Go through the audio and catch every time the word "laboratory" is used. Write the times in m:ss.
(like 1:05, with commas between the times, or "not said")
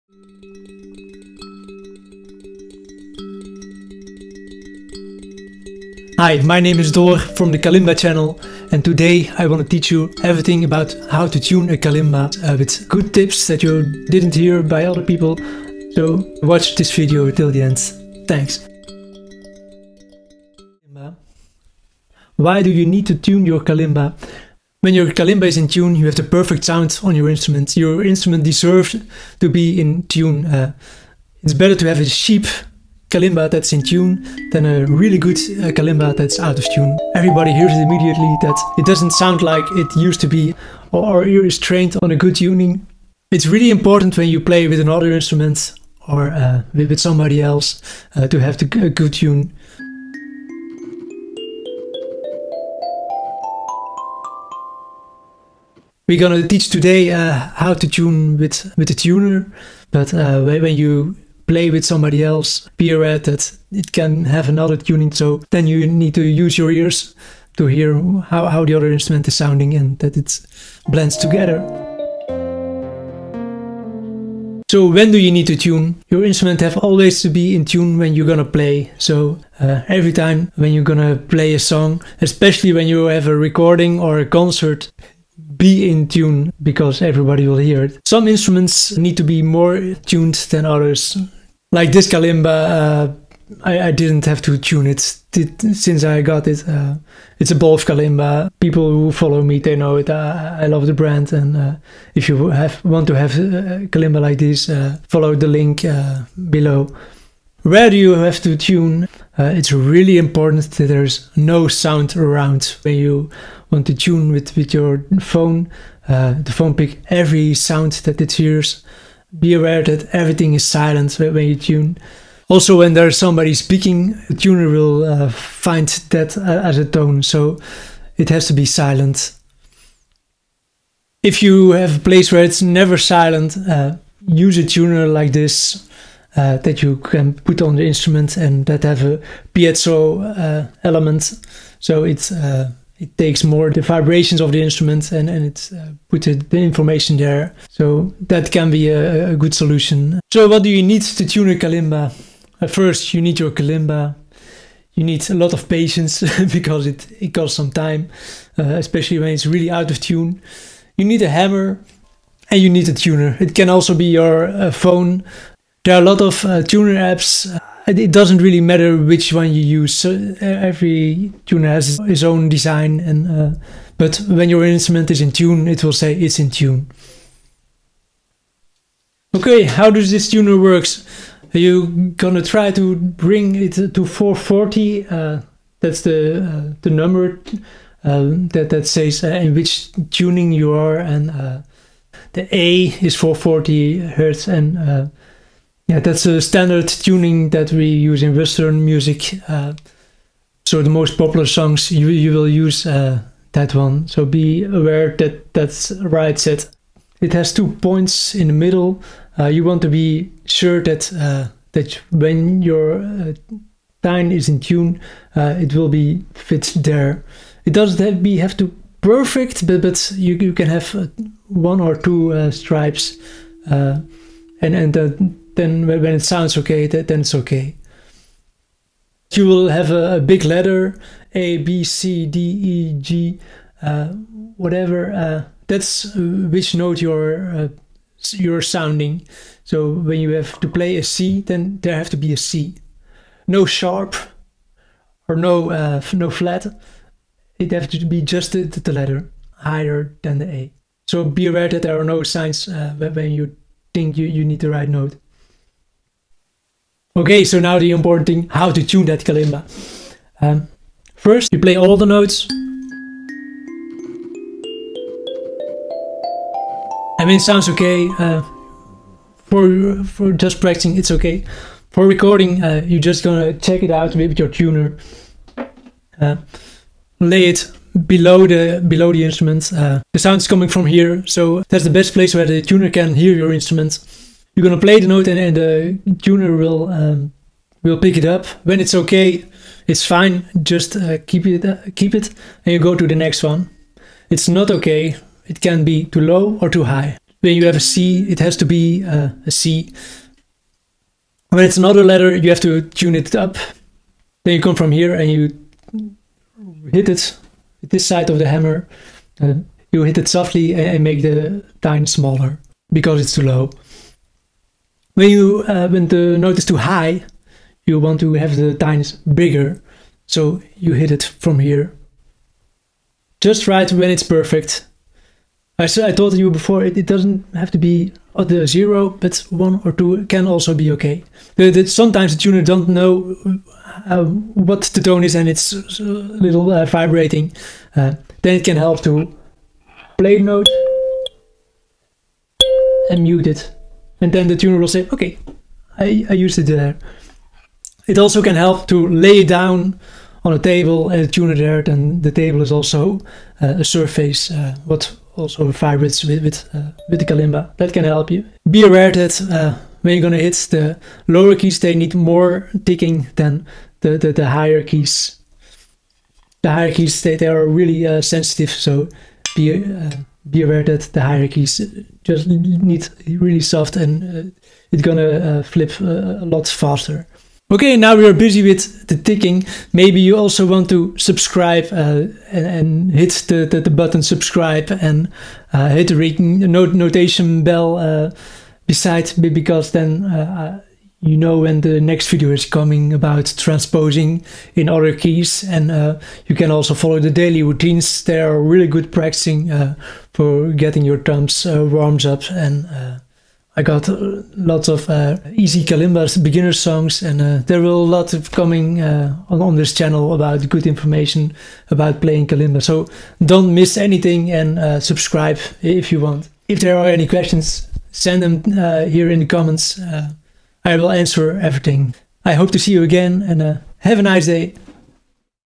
not said.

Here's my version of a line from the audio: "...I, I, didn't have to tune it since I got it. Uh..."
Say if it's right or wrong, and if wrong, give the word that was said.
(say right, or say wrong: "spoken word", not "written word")
right.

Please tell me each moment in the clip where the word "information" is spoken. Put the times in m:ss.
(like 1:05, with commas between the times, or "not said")
2:26, 6:50.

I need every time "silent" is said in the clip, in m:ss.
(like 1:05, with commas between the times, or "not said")
2:00, 2:08, 2:12.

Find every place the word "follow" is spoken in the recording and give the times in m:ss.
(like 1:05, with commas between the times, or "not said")
1:39, 1:45, 6:36.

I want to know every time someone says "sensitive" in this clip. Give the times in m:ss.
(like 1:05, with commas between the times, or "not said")
6:08.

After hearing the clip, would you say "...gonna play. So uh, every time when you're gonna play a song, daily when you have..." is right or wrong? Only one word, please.
wrong.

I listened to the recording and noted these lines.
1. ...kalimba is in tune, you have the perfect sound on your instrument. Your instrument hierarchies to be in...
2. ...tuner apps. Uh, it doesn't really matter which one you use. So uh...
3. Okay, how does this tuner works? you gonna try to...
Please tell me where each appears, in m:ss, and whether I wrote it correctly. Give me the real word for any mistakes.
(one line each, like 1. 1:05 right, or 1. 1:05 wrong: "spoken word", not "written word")
1. 0:25 wrong: "deserves", not "hierarchies"
2. 2:46 right
3. 2:59 right.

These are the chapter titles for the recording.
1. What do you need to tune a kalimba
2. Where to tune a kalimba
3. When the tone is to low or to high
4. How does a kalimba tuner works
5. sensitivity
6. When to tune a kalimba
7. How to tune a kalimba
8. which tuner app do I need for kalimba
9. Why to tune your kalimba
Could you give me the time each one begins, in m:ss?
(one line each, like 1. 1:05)
1. 2:30
2. 1:47
3. 5:09
4. 2:58
5. 5:58
6. 1:24
7. 4:18
8. 2:45
9. 0:24.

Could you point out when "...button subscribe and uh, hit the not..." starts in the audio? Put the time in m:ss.
6:23.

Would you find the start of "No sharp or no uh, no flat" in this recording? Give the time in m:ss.
4:03.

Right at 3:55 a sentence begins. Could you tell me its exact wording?
Uh, that's uh, which note you're uh, you're sounding.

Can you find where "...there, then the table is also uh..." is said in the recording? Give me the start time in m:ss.
5:51.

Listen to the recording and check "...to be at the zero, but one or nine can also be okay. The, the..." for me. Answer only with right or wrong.
wrong.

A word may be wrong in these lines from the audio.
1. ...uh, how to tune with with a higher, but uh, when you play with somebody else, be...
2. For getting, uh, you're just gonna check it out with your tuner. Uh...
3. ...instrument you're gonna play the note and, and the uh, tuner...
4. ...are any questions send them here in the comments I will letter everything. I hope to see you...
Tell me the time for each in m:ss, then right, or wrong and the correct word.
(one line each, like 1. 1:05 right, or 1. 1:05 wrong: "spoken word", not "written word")
1. 0:57 wrong: "tuner", not "higher"
2. 4:31 wrong: "recording", not "getting"
3. 4:43 right
4. 6:56 wrong: "answer", not "letter".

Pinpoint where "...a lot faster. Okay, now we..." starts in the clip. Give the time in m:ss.
6:16.